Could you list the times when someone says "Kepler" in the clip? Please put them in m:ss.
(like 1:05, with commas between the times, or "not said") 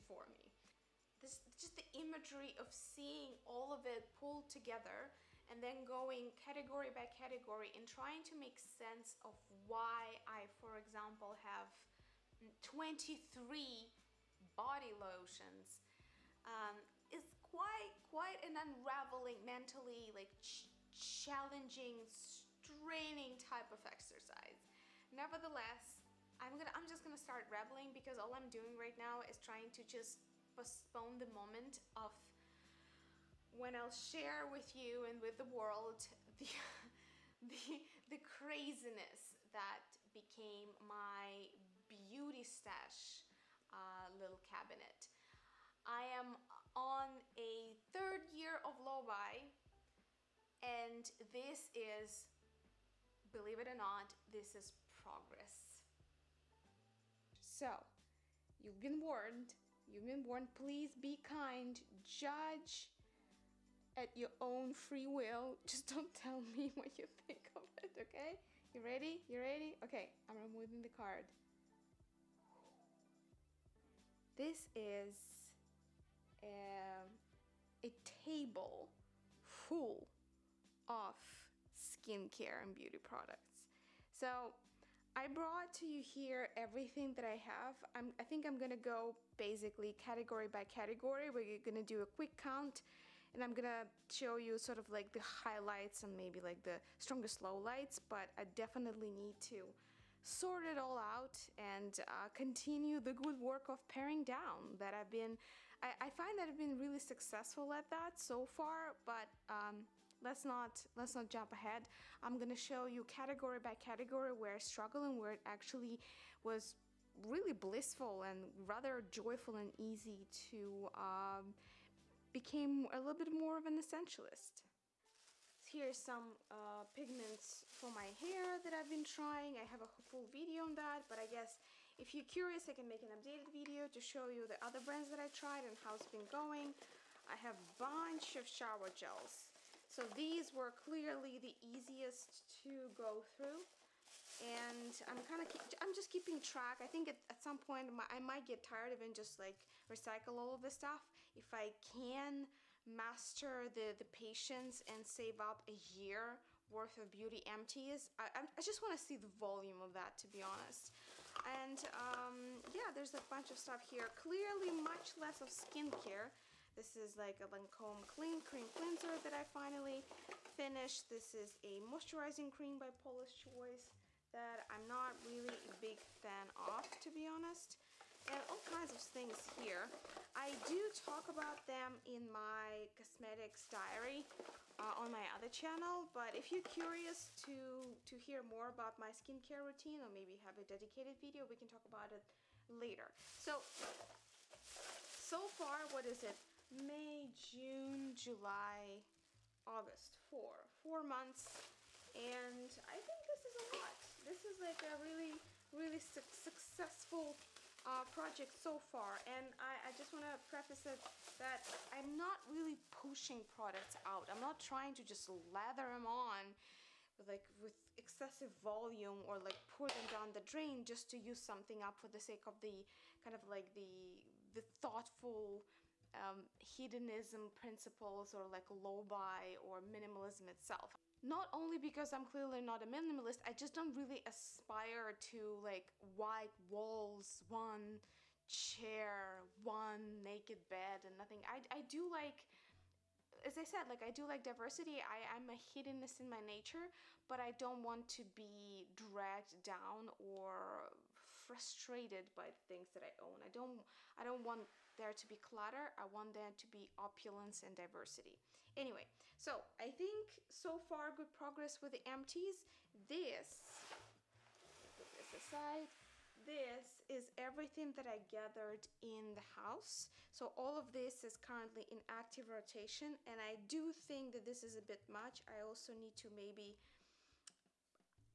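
not said.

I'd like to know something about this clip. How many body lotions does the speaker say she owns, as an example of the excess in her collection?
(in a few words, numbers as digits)
23.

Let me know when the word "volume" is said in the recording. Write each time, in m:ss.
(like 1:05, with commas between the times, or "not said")
2:39, 3:38.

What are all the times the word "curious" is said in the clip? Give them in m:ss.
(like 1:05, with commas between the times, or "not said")
2:12, 3:06.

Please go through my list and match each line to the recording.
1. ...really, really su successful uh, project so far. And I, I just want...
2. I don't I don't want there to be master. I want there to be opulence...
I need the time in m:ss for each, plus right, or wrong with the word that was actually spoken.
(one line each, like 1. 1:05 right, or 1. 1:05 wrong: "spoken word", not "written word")
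1. 3:25 right
2. 4:13 wrong: "clutter", not "master".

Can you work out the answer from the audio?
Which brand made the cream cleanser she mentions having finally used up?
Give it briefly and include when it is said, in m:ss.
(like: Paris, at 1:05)
Lancome, at 2:47.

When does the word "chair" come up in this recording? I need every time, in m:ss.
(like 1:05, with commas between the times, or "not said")
3:58.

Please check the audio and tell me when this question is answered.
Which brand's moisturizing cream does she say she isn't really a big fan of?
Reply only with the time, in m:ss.
2:52.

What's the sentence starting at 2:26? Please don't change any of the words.
I think at, at some point my, I might get tired of and just like recycle all of this stuff.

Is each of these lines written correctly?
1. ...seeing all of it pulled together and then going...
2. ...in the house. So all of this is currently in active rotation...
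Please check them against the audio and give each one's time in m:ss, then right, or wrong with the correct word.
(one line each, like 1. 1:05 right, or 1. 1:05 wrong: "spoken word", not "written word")
1. 0:02 right
2. 4:28 right.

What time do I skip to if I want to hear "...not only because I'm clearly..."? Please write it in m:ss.
3:51.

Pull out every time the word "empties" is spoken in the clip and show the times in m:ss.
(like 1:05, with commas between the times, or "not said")
2:37, 4:22.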